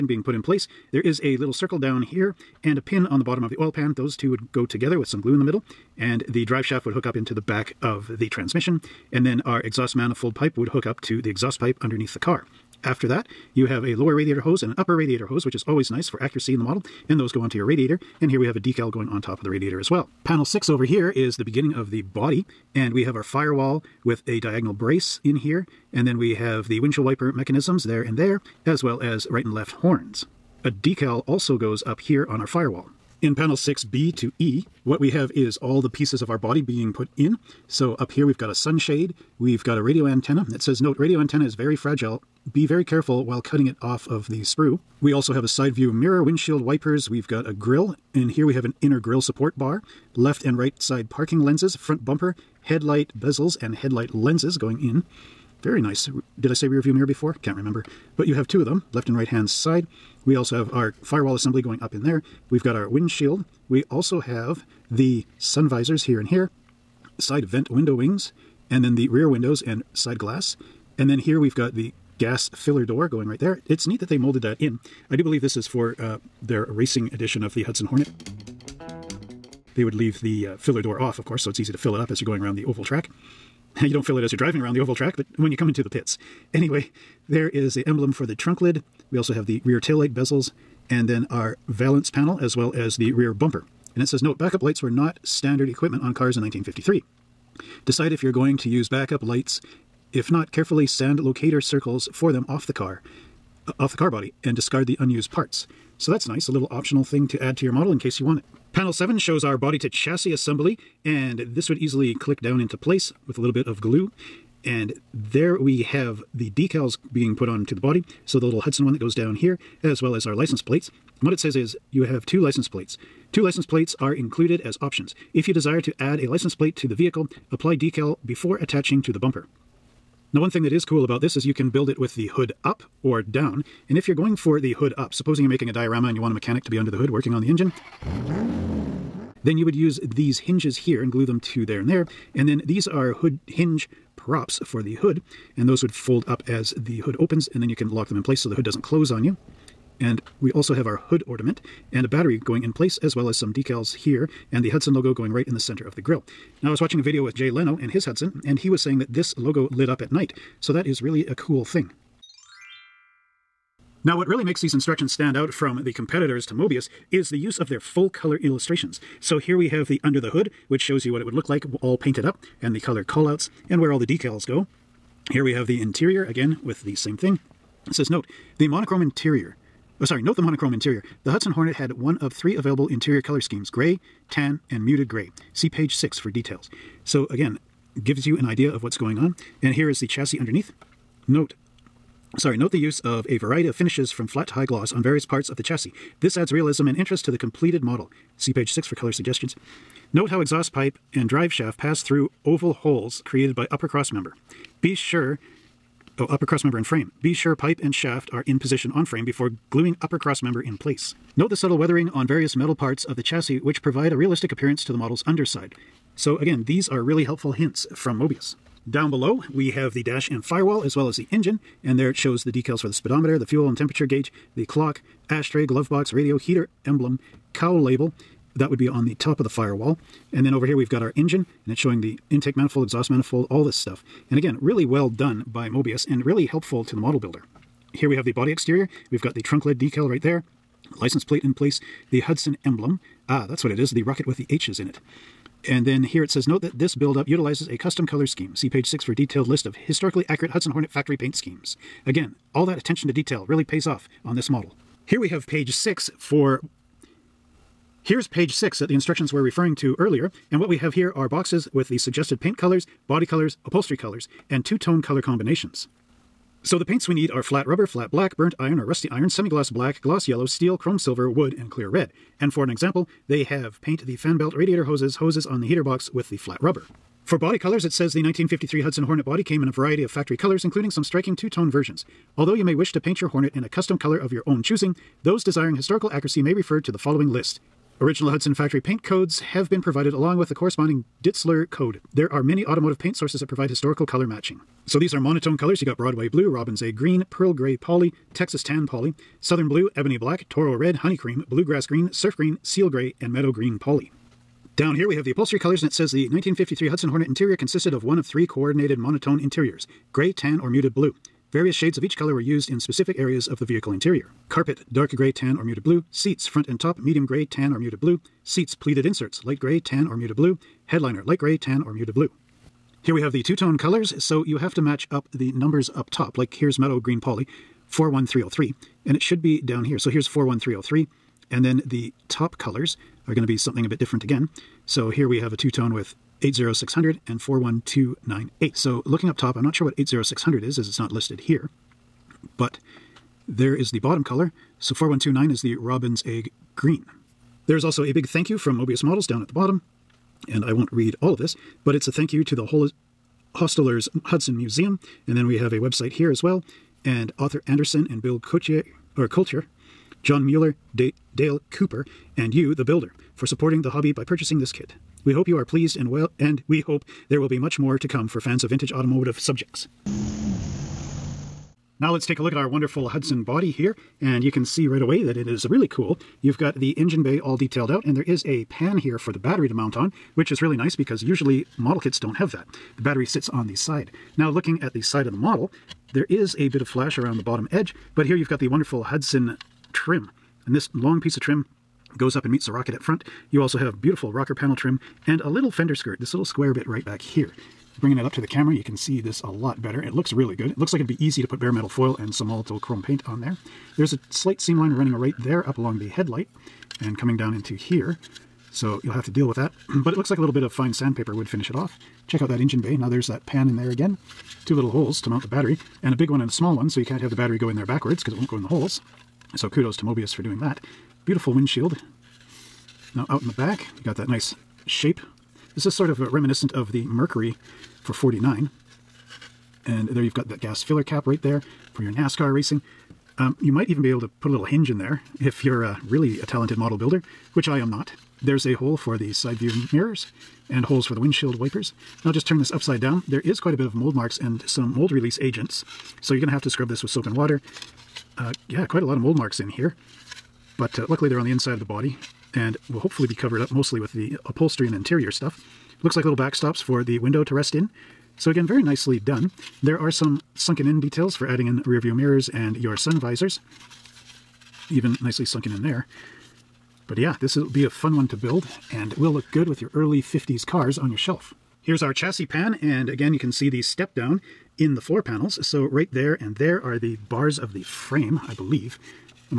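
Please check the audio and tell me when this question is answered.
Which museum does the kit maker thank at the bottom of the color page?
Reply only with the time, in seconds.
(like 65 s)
353 s.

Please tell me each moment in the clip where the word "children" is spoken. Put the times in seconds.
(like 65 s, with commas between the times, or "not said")
not said.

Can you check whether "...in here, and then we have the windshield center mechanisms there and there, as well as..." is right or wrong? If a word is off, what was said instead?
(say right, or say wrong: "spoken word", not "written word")
wrong: "wiper", not "center".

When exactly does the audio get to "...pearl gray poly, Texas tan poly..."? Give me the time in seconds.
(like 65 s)
297 s.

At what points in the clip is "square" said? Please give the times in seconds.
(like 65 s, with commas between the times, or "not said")
396 s.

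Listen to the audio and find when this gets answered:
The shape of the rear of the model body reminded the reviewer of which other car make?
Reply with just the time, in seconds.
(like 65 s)
427 s.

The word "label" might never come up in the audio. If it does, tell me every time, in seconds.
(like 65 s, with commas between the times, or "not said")
227 s.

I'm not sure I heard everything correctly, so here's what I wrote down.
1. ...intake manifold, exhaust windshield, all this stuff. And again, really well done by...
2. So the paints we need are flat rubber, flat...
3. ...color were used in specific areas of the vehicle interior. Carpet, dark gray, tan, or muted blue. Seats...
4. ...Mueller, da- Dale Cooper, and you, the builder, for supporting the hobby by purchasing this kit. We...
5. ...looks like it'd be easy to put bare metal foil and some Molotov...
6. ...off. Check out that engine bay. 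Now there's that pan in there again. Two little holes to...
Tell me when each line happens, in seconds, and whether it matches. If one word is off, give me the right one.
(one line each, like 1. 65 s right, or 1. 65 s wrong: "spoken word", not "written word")
1. 232 s wrong: "manifold", not "windshield"
2. 266 s right
3. 312 s right
4. 360 s right
5. 400 s right
6. 411 s right.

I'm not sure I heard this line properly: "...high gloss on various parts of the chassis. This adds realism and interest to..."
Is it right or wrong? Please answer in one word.
right.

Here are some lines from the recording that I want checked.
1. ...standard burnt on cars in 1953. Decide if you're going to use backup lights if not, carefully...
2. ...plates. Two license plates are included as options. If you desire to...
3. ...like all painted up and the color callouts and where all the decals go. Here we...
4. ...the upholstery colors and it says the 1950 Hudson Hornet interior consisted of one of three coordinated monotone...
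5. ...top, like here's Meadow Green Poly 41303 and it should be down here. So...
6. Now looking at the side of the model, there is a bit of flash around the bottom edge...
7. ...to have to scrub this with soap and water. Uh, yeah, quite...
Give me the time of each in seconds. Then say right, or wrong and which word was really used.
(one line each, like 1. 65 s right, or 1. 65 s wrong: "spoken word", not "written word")
1. 95 s wrong: "equipment", not "burnt"
2. 122 s right
3. 171 s right
4. 305 s wrong: "1953", not "1950"
5. 326 s right
6. 384 s right
7. 446 s right.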